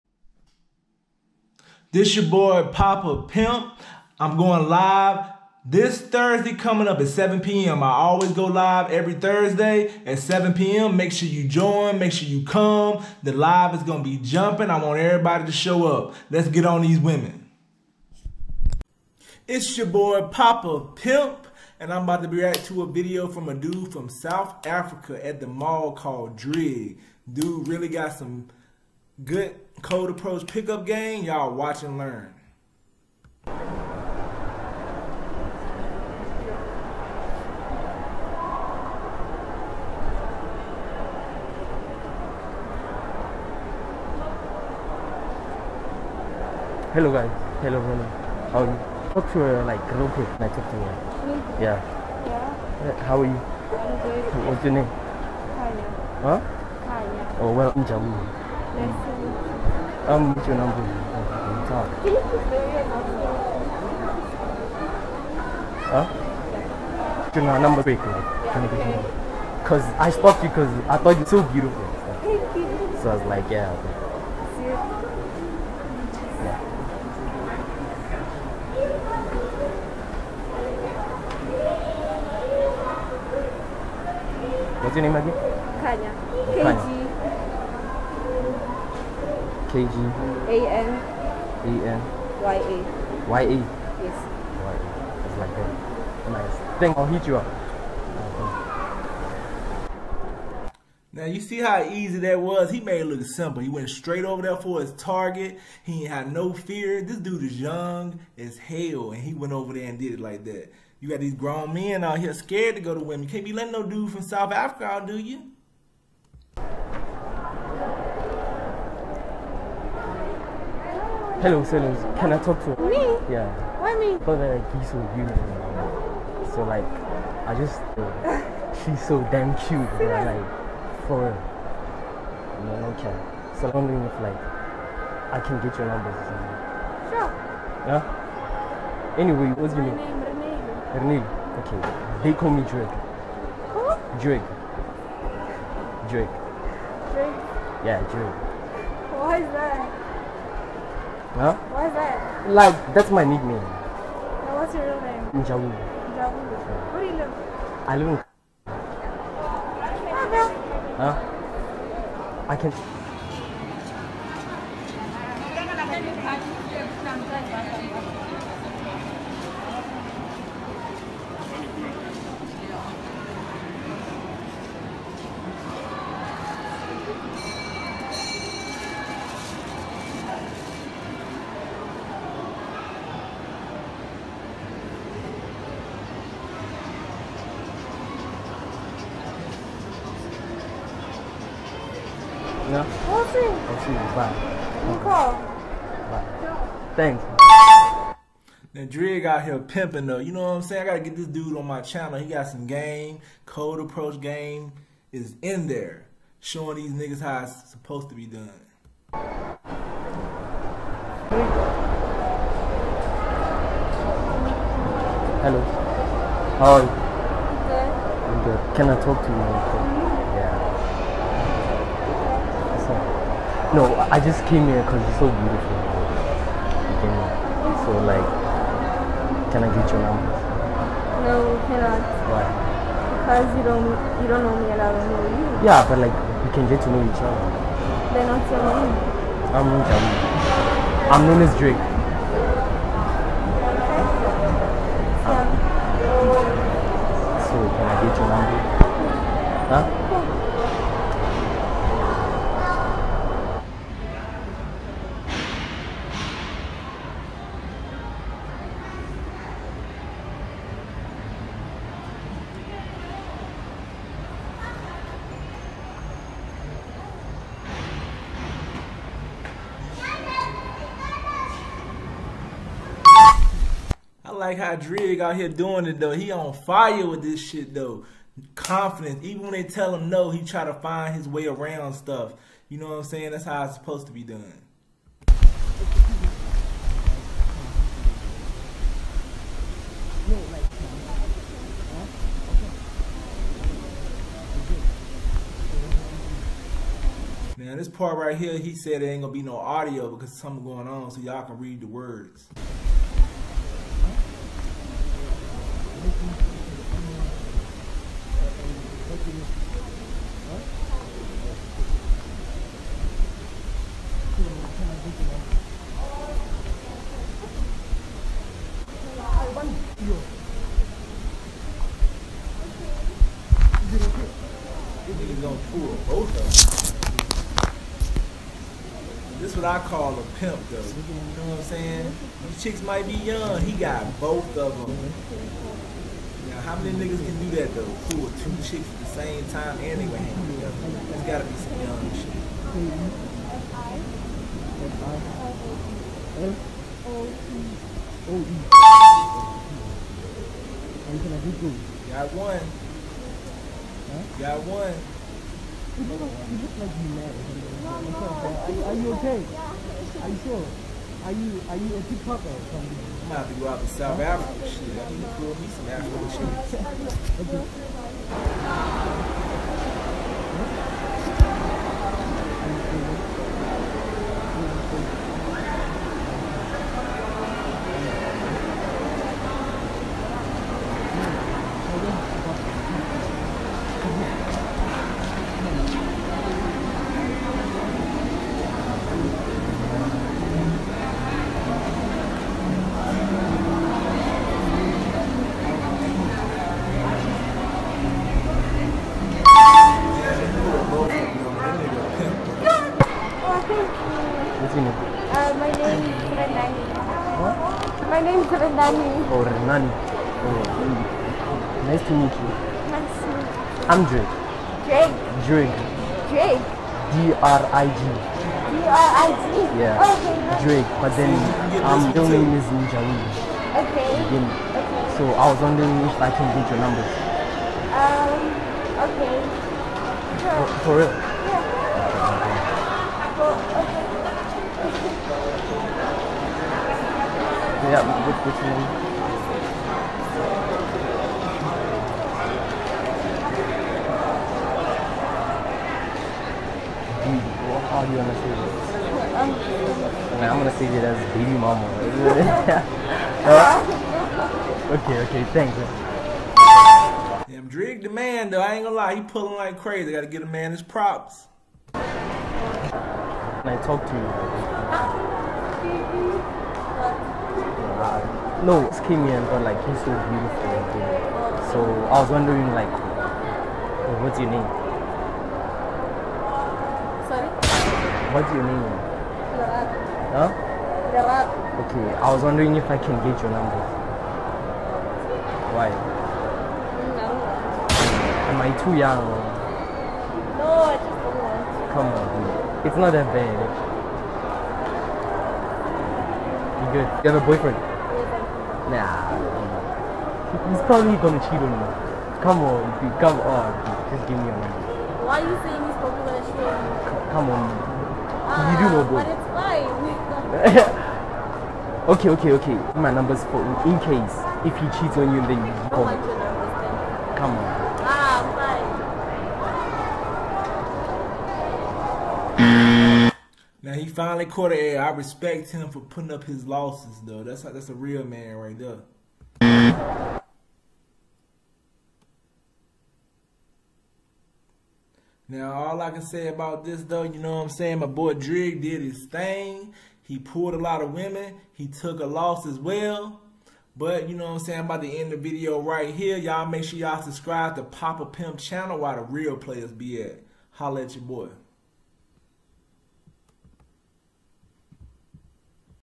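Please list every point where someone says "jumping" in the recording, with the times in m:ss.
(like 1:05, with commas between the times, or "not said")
0:14.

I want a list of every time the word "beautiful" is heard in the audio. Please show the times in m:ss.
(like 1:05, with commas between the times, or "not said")
1:11, 2:05, 3:45, 7:50.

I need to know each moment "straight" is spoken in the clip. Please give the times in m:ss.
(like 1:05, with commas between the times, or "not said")
1:43.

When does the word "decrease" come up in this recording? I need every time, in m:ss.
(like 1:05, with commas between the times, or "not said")
not said.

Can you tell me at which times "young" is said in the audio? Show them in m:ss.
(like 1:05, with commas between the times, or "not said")
1:47, 5:33, 5:41, 8:08.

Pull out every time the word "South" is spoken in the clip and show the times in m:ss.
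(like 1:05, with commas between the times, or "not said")
0:24, 1:54, 6:03.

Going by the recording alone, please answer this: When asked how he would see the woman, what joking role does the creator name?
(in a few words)
baby mama.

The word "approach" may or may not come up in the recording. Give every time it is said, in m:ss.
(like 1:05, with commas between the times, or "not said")
0:30, 3:23.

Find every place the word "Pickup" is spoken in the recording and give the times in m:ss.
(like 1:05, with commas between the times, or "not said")
0:30.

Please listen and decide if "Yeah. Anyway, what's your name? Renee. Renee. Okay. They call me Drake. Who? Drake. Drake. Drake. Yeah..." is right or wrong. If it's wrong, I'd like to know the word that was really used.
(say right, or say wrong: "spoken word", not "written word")
right.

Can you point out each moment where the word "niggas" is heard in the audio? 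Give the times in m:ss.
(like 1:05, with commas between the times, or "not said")
3:26, 5:36.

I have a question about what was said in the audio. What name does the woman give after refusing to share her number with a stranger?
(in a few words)
Jamie.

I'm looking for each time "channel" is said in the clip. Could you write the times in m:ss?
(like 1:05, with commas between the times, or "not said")
3:21, 9:08.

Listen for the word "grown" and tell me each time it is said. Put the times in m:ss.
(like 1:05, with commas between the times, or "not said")
1:51.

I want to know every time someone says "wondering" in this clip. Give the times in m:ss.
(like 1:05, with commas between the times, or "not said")
2:13, 7:05, 7:52, 8:02.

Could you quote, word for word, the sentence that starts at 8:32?
My number's for in case if he cheats on you, then oh you call.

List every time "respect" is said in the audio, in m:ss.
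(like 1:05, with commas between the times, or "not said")
8:45.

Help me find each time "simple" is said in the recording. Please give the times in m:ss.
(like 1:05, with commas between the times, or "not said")
1:43.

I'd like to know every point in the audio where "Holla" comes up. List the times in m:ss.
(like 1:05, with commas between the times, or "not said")
9:10.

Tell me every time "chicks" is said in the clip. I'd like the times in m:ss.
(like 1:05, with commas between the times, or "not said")
5:32, 5:38.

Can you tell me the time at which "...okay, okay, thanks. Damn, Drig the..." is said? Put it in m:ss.
7:34.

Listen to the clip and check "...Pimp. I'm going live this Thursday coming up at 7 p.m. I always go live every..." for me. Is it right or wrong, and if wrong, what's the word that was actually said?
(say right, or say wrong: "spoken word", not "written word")
right.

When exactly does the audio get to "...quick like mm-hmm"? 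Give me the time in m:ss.
0:50.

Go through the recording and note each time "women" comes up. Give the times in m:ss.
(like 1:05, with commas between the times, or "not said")
0:16, 1:52, 9:01.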